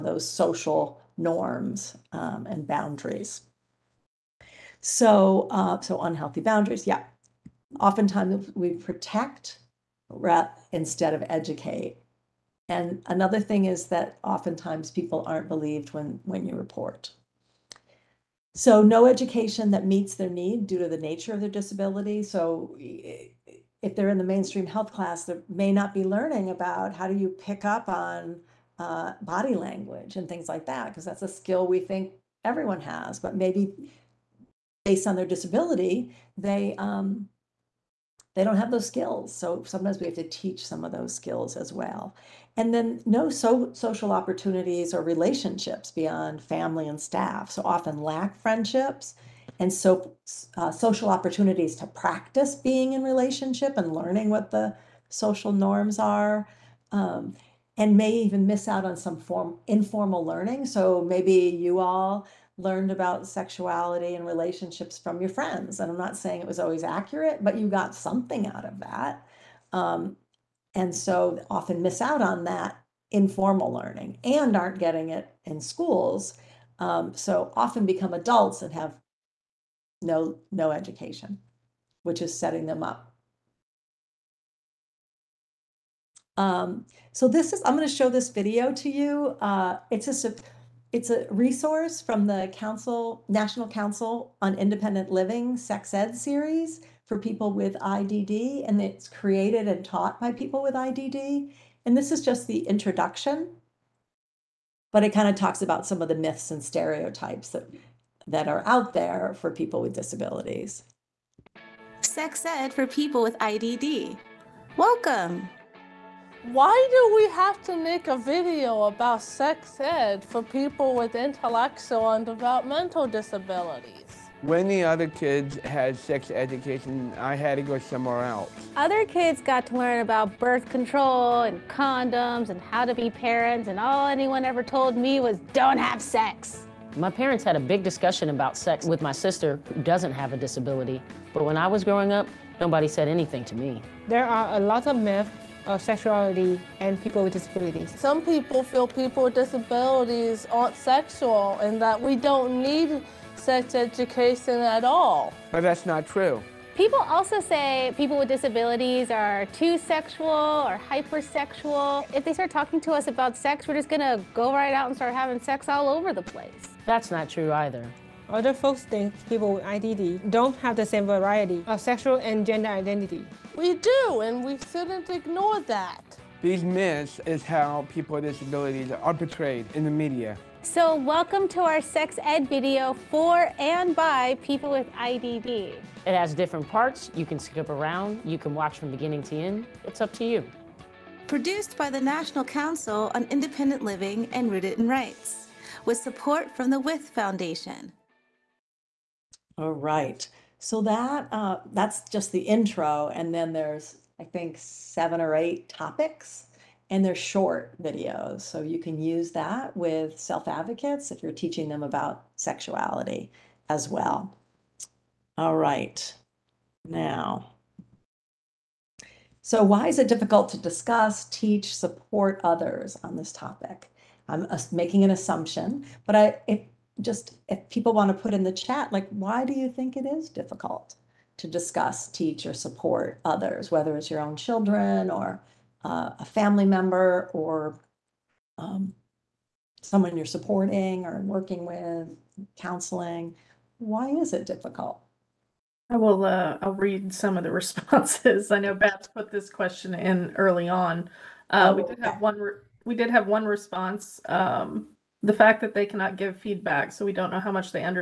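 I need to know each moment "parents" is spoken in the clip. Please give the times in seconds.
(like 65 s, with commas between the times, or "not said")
133 s, 137 s.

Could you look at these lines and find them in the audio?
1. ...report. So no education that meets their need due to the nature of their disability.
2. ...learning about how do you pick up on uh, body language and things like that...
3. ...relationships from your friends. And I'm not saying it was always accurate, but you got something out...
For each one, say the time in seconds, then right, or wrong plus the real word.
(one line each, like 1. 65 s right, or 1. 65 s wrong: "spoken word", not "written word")
1. 16 s right
2. 26 s right
3. 64 s right.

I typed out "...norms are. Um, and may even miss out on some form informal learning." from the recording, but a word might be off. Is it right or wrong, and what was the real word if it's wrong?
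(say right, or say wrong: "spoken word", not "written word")
right.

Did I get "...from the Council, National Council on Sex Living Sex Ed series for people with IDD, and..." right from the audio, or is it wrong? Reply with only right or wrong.
wrong.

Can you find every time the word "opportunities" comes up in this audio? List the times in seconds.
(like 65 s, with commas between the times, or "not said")
44 s, 51 s.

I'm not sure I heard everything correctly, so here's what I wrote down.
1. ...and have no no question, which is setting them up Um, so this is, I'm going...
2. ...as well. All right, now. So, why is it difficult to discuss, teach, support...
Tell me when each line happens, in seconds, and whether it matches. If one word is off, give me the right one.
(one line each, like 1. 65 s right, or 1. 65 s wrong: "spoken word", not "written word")
1. 78 s wrong: "education", not "question"
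2. 213 s right.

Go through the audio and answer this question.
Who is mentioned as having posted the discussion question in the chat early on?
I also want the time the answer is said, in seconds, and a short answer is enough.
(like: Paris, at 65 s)
Beth, at 248 s.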